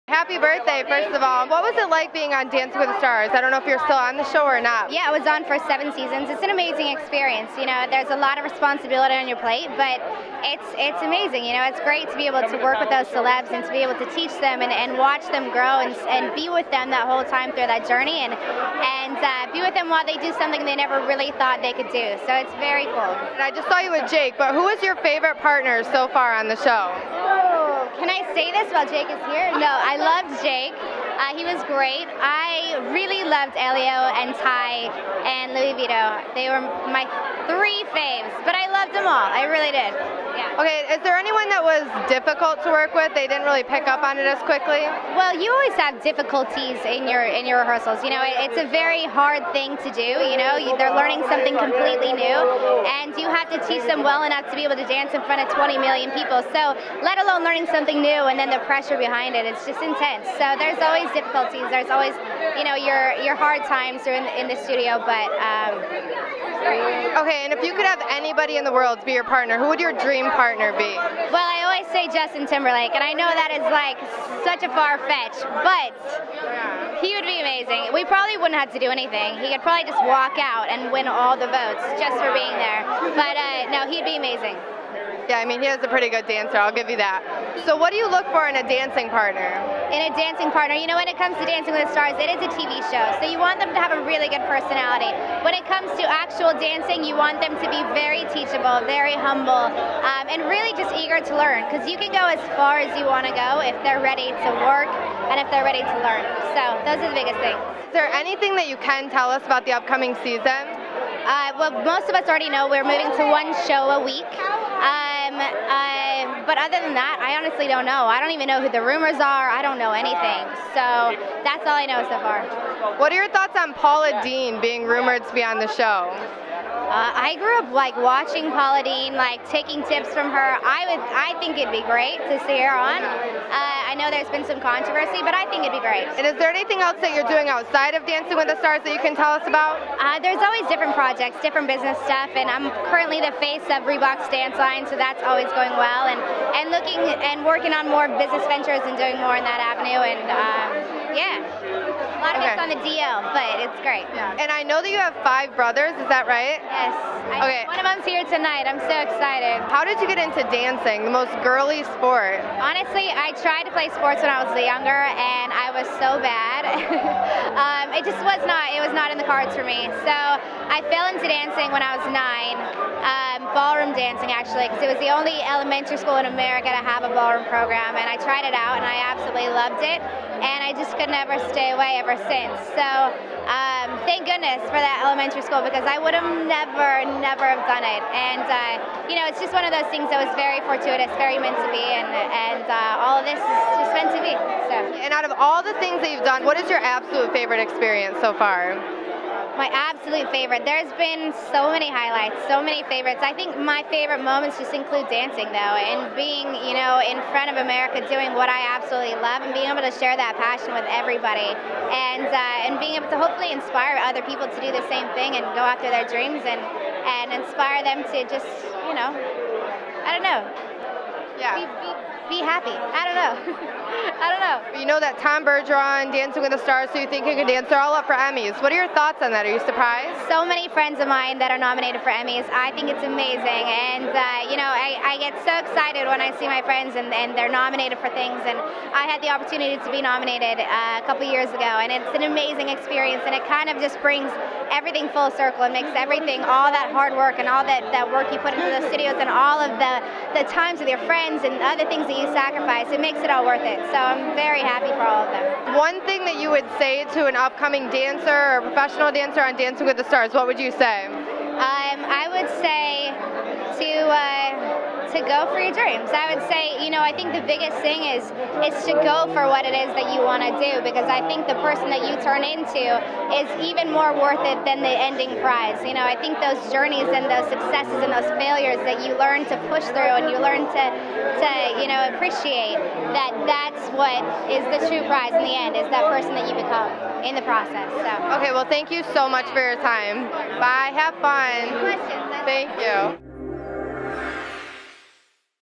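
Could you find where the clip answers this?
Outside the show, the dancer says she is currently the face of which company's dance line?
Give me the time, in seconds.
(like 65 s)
143 s.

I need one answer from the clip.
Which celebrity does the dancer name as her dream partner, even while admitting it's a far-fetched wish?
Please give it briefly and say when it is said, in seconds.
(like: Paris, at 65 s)
Justin Timberlake, at 72 s.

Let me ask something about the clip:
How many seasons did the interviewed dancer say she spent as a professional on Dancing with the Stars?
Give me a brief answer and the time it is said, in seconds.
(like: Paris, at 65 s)
7, at 5 s.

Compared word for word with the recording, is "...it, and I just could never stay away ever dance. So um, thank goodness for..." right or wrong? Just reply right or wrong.
wrong.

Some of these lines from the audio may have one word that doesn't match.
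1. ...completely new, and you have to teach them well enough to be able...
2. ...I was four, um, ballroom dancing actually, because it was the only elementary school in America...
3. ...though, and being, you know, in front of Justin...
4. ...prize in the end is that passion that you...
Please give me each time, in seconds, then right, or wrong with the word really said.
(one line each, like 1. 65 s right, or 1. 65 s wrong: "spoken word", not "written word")
1. 51 s right
2. 171 s wrong: "nine", not "four"
3. 205 s wrong: "America", not "Justin"
4. 285 s wrong: "person", not "passion".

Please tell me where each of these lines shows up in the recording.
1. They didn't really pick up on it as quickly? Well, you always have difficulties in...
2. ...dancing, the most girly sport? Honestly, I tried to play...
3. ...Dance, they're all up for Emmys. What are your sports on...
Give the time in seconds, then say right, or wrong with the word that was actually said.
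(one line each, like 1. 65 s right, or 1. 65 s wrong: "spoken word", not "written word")
1. 43 s right
2. 160 s right
3. 227 s wrong: "thoughts", not "sports".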